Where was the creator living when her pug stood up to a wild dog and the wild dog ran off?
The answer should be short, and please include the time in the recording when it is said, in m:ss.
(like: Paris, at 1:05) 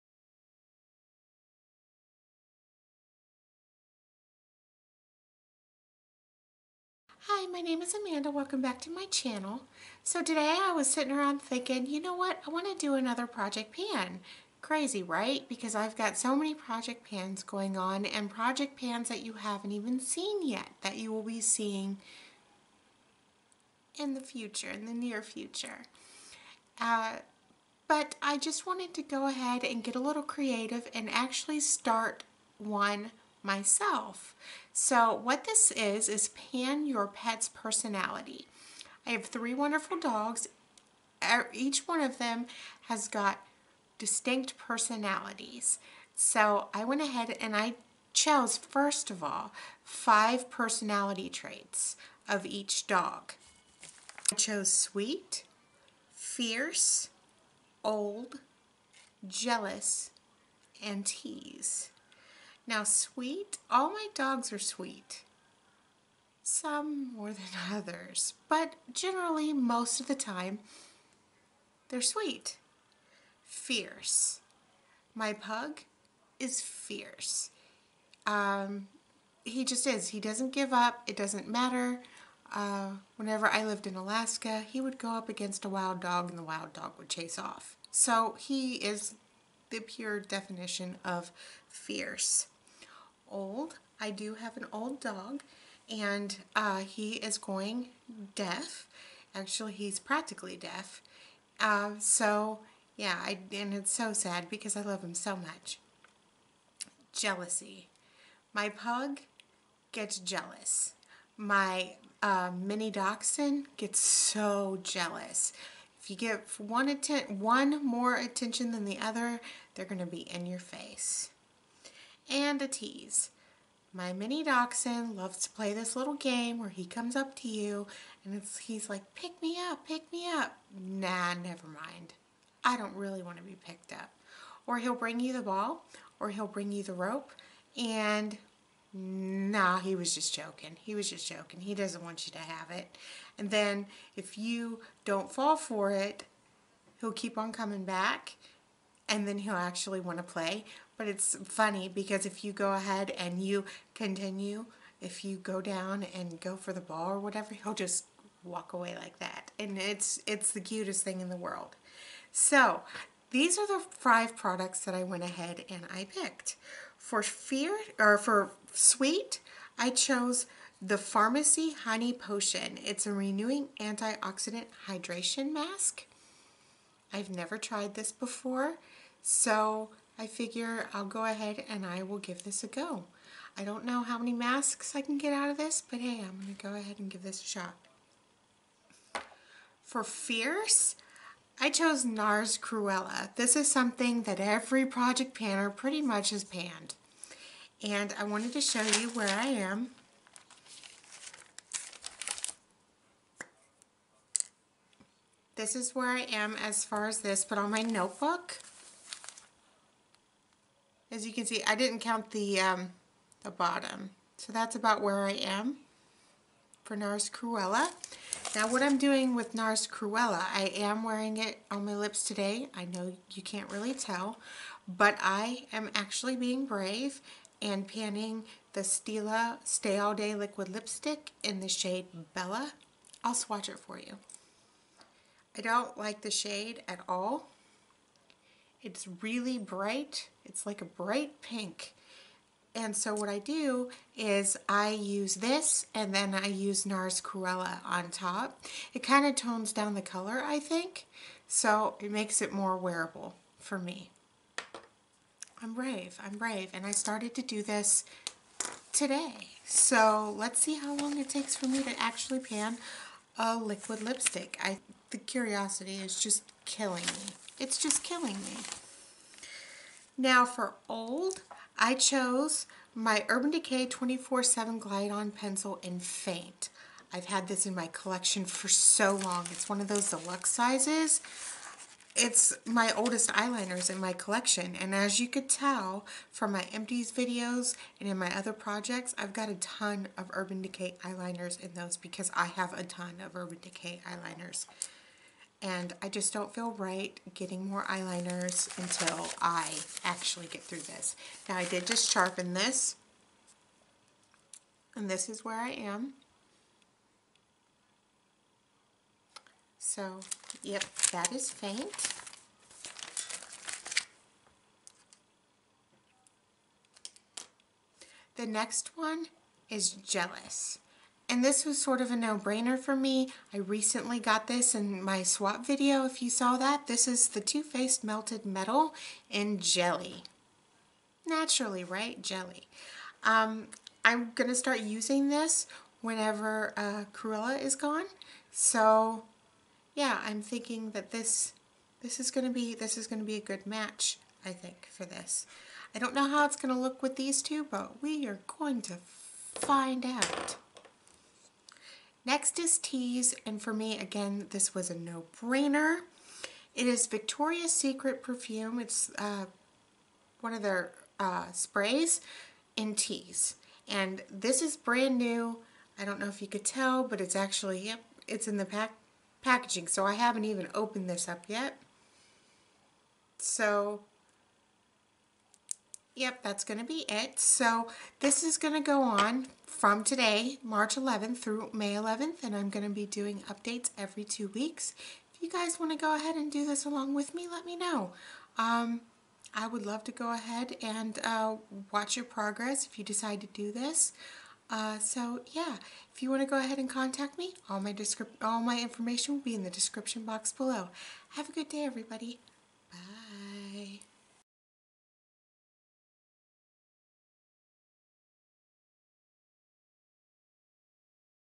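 Alaska, at 1:23.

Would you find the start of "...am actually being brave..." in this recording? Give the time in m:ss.
3:45.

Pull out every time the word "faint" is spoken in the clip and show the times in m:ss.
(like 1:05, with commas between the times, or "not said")
4:36, 5:11.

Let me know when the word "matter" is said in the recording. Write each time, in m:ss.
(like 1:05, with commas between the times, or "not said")
1:21.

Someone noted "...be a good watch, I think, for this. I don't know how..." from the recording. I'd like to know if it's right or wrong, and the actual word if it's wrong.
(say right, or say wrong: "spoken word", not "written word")
wrong: "match", not "watch".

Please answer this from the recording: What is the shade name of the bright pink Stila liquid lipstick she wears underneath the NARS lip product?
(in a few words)
Bella.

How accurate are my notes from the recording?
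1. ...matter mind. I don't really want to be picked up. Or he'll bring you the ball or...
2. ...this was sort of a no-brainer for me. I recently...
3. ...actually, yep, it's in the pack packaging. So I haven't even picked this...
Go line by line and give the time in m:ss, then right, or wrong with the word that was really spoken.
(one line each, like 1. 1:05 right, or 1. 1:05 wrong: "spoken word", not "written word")
1. 2:11 wrong: "never", not "matter"
2. 5:21 right
3. 6:07 wrong: "opened", not "picked".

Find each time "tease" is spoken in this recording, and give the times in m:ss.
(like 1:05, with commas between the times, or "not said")
1:01, 2:02, 5:52, 6:02.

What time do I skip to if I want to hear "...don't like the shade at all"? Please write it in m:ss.
3:55.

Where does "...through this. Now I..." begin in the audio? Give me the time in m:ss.
5:00.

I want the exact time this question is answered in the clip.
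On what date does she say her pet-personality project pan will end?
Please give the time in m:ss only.
6:21.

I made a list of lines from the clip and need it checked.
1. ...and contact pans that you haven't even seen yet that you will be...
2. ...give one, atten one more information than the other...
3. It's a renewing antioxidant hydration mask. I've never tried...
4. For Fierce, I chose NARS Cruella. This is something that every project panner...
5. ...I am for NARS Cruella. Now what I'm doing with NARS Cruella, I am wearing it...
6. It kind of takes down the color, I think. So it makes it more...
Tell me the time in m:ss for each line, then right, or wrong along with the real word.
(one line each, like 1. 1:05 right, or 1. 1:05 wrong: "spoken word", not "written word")
1. 0:18 wrong: "project", not "contact"
2. 1:56 wrong: "attention", not "information"
3. 2:52 right
4. 3:09 right
5. 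3:35 right
6. 4:08 wrong: "tones", not "takes".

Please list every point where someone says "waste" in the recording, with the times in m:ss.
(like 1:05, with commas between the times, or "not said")
not said.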